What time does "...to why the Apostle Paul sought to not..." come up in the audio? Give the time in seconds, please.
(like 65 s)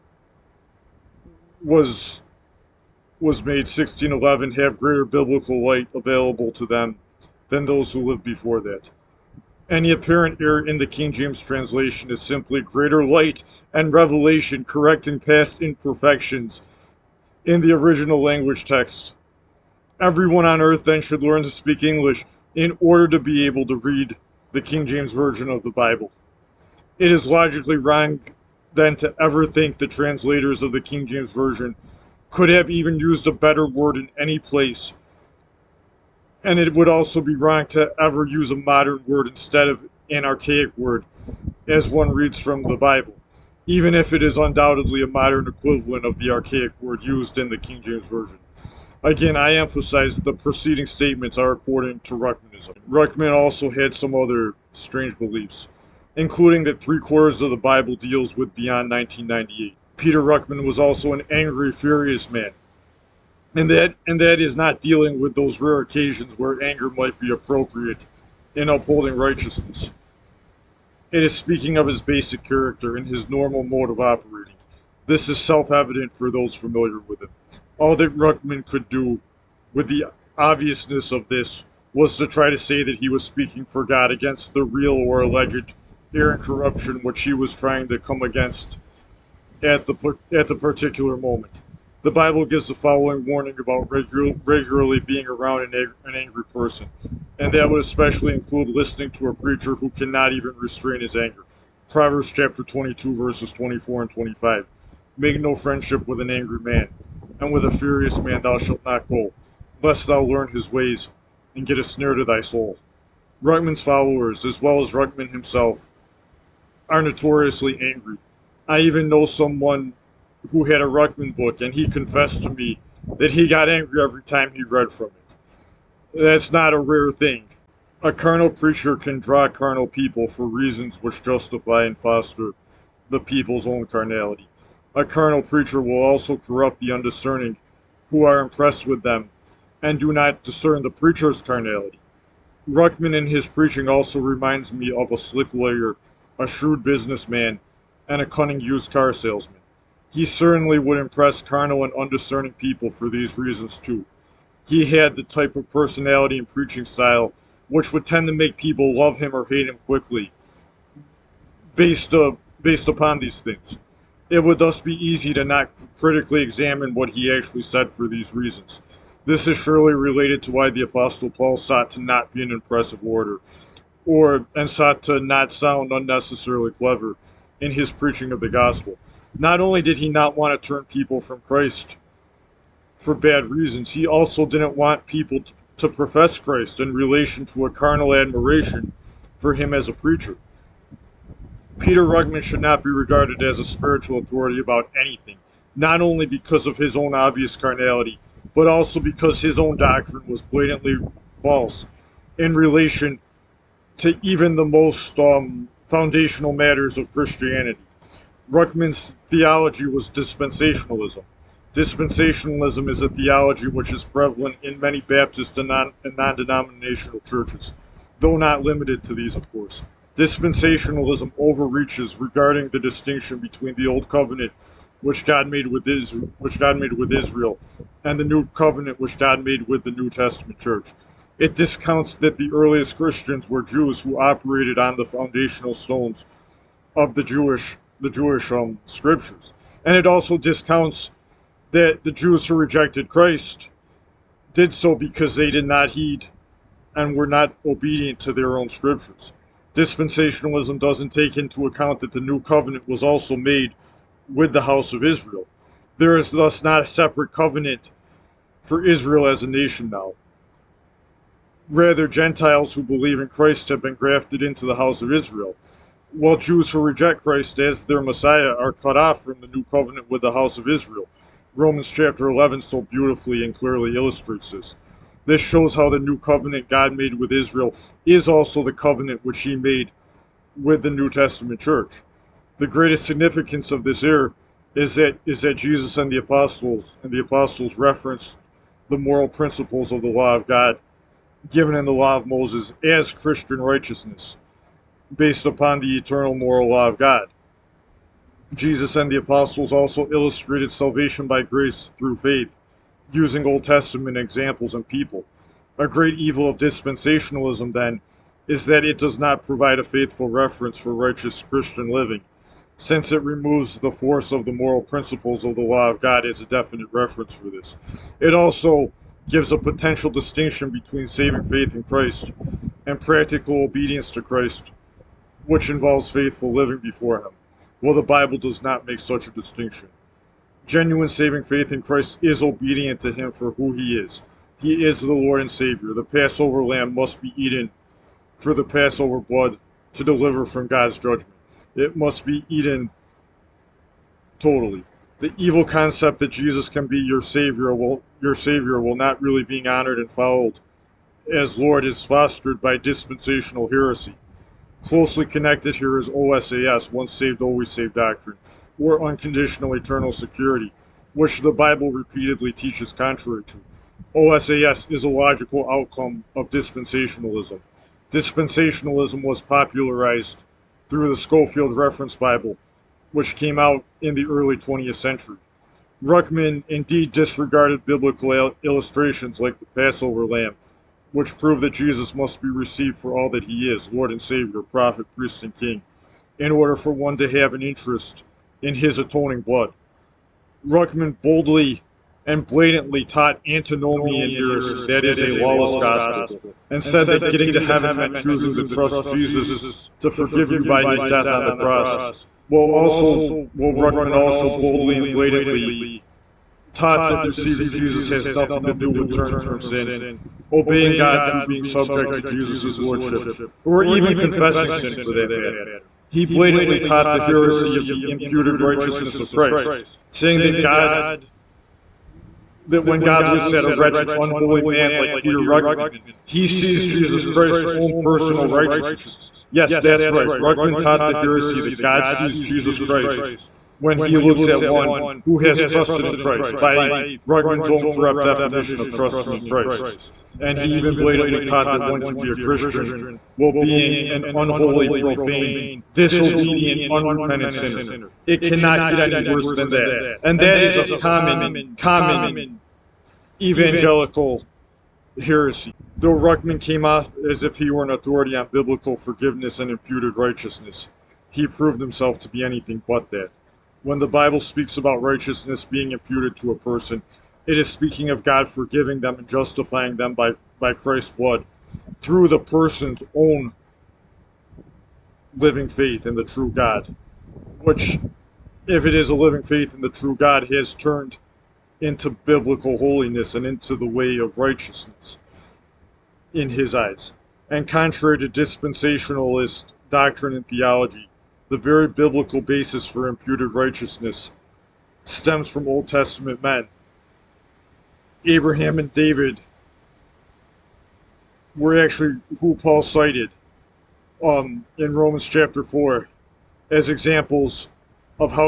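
170 s.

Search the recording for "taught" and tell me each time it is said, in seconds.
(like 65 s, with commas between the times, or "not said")
393 s, 406 s, 416 s, 430 s, 441 s.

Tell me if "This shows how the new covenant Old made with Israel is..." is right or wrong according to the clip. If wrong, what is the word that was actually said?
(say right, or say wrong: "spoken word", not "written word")
wrong: "God", not "Old".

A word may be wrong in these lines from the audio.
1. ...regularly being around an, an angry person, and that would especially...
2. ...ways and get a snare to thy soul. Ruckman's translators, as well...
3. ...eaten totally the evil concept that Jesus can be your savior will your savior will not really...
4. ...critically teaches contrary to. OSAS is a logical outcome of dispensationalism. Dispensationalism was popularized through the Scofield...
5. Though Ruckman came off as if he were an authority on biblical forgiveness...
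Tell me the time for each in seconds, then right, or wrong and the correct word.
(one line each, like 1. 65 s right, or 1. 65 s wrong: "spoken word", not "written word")
1. 94 s right
2. 110 s wrong: "followers", not "translators"
3. 342 s right
4. 361 s wrong: "repeatedly", not "critically"
5. 455 s right.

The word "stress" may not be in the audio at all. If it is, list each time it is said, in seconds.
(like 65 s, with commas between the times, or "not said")
not said.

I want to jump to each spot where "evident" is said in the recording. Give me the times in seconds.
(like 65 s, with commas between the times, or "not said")
75 s.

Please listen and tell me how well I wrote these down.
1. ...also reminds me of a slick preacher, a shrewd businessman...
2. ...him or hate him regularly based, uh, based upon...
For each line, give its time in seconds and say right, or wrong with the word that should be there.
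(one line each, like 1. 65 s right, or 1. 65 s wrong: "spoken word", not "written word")
1. 143 s wrong: "lawyer", not "preacher"
2. 159 s wrong: "quickly", not "regularly".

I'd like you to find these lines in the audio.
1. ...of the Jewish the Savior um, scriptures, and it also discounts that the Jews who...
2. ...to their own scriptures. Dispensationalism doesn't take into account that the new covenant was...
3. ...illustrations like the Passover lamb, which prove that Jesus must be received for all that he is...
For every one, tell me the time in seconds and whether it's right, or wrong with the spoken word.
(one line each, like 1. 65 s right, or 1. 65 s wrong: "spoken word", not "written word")
1. 236 s wrong: "Jewish", not "Savior"
2. 248 s right
3. 378 s right.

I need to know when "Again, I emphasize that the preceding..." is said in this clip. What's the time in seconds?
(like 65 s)
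49 s.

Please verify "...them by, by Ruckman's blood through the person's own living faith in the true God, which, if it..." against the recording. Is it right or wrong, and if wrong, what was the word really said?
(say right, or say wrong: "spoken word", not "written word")
wrong: "Christ", not "Ruckman".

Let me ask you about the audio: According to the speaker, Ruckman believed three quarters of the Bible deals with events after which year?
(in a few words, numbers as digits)
1998.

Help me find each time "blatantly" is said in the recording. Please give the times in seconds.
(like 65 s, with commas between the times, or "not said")
200 s, 392 s, 405 s, 416 s, 440 s.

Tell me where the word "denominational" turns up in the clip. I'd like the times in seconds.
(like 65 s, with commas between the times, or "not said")
216 s.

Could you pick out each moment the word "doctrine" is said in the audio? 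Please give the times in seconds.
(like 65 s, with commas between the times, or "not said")
199 s, 357 s, 489 s.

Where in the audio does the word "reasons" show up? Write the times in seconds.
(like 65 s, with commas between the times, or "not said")
130 s, 153 s, 168 s, 183 s.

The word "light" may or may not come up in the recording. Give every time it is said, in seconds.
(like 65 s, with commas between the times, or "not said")
5 s, 13 s.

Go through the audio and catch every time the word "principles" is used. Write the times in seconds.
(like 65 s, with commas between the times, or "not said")
289 s, 314 s.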